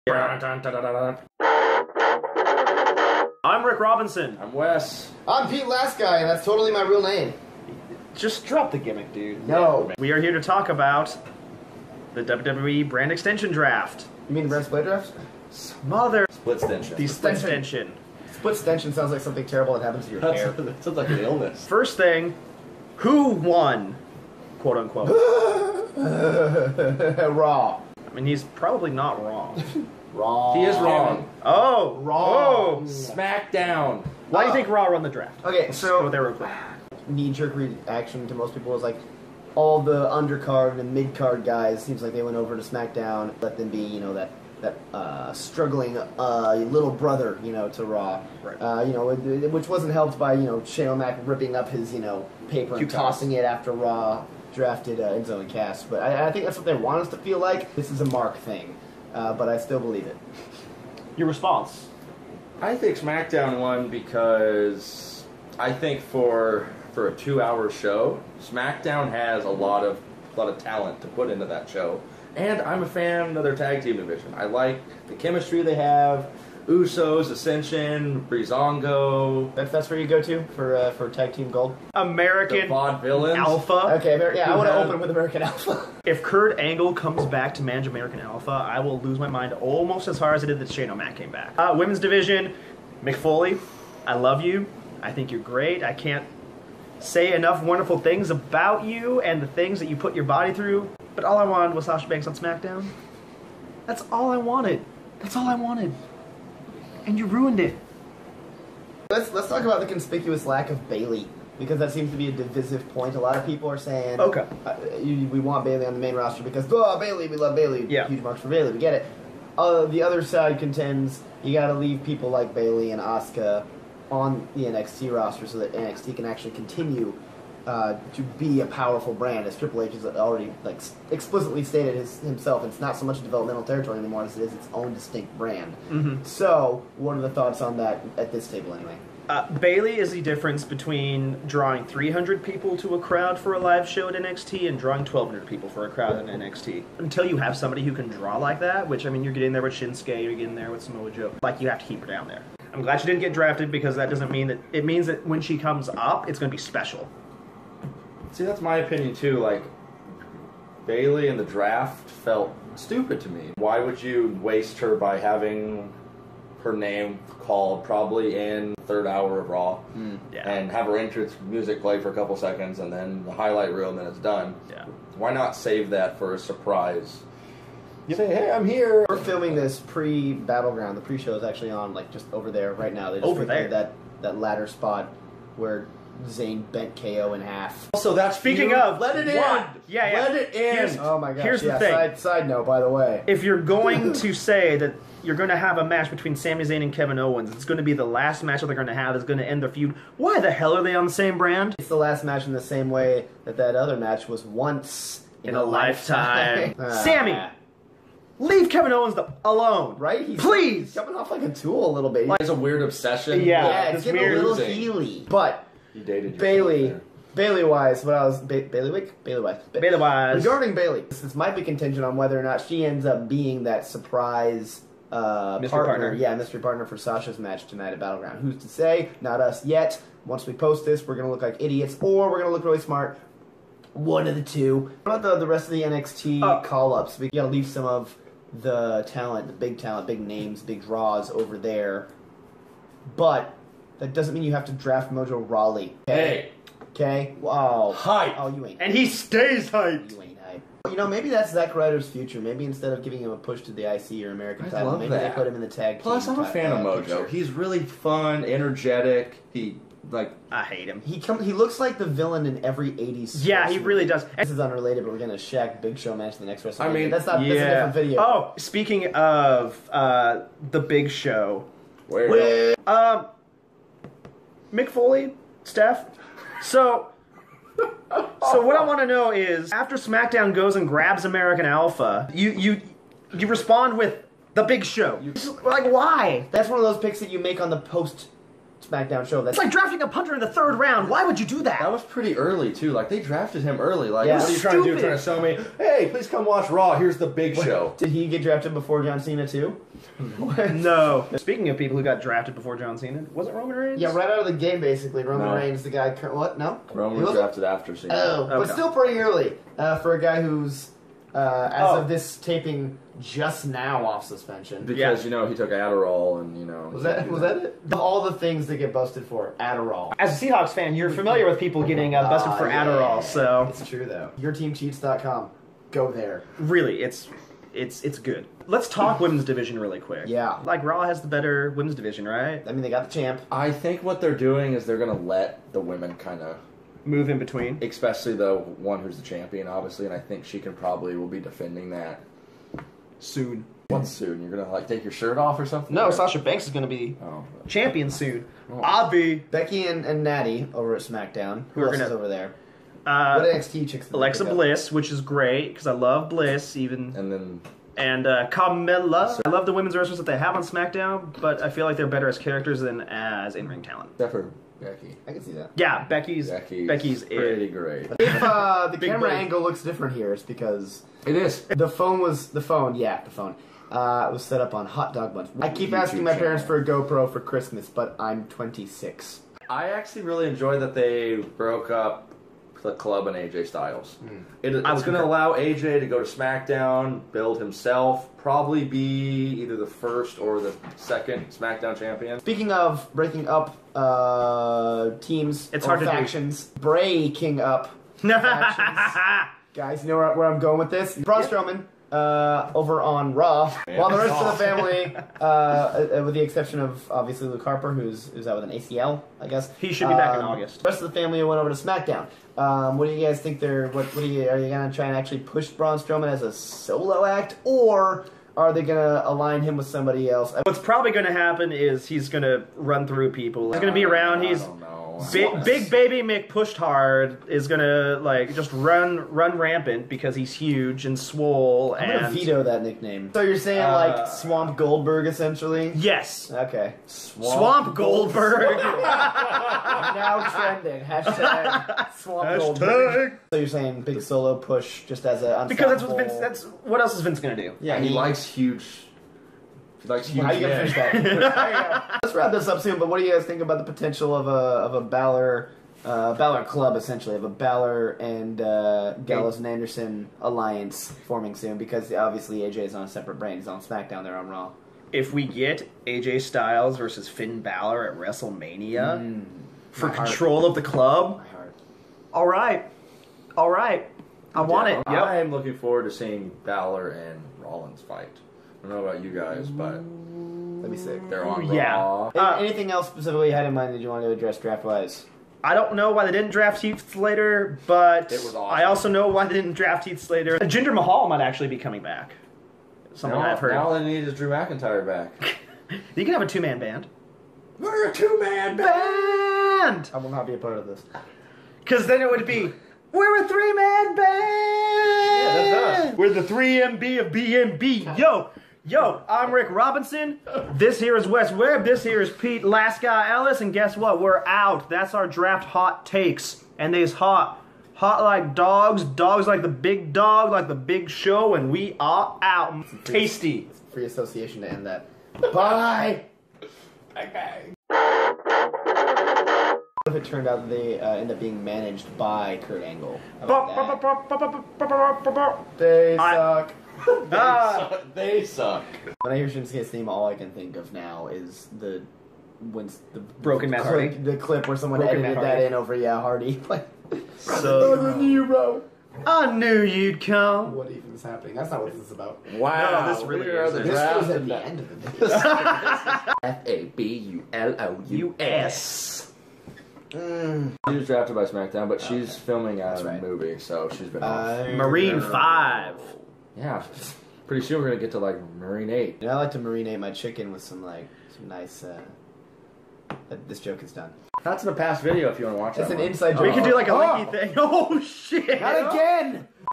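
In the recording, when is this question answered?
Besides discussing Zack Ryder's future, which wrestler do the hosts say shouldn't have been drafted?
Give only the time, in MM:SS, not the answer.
04:05.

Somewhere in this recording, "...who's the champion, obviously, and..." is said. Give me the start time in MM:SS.
05:39.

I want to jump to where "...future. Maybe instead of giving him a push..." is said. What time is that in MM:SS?
04:12.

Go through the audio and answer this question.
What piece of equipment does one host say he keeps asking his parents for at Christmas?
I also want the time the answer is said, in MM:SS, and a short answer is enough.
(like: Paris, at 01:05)
GoPro, at 06:16.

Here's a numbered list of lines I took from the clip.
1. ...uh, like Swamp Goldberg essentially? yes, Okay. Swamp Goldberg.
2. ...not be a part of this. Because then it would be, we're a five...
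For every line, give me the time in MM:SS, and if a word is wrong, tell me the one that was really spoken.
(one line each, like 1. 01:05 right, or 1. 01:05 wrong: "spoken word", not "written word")
1. 07:13 right
2. 08:20 wrong: "three", not "five".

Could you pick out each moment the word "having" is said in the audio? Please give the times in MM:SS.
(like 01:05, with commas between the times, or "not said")
02:45.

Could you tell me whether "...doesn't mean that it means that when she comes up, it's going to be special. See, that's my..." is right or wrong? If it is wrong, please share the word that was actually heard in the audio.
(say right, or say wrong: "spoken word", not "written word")
right.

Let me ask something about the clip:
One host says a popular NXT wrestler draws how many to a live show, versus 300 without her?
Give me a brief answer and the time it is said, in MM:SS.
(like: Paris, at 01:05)
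1,200, at 02:25.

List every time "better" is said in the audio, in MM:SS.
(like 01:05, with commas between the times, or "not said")
05:31, 06:02.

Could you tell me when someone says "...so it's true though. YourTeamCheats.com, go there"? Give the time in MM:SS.
05:23.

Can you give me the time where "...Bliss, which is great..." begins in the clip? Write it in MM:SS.
05:54.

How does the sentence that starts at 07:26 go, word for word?
That's what else is Vince gonna do?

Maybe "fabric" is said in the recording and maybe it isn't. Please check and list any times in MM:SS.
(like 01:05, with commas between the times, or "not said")
not said.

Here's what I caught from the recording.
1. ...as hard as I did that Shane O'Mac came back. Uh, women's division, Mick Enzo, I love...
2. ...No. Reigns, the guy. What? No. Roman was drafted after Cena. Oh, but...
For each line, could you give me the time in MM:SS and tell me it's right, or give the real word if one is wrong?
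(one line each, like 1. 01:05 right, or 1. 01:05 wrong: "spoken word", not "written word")
1. 01:30 wrong: "Foley", not "Enzo"
2. 05:05 right.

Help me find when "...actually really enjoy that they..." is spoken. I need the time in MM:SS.
06:19.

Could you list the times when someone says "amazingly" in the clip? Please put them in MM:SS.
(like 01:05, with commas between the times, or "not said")
not said.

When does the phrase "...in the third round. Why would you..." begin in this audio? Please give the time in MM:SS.
04:50.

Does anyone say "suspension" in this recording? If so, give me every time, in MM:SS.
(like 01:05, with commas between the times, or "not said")
05:14.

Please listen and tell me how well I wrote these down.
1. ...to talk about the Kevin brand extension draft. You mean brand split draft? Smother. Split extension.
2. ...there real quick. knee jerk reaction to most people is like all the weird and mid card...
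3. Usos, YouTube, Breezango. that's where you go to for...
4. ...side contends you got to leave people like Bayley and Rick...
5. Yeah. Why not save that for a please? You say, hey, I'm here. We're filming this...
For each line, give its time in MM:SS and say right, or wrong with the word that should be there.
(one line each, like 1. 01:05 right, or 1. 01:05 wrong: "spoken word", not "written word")
1. 00:10 wrong: "WWE", not "Kevin"
2. 00:36 wrong: "undercard", not "weird"
3. 01:16 wrong: "Ascension", not "YouTube"
4. 02:00 wrong: "Asuka", not "Rick"
5. 02:54 wrong: "surprise", not "please".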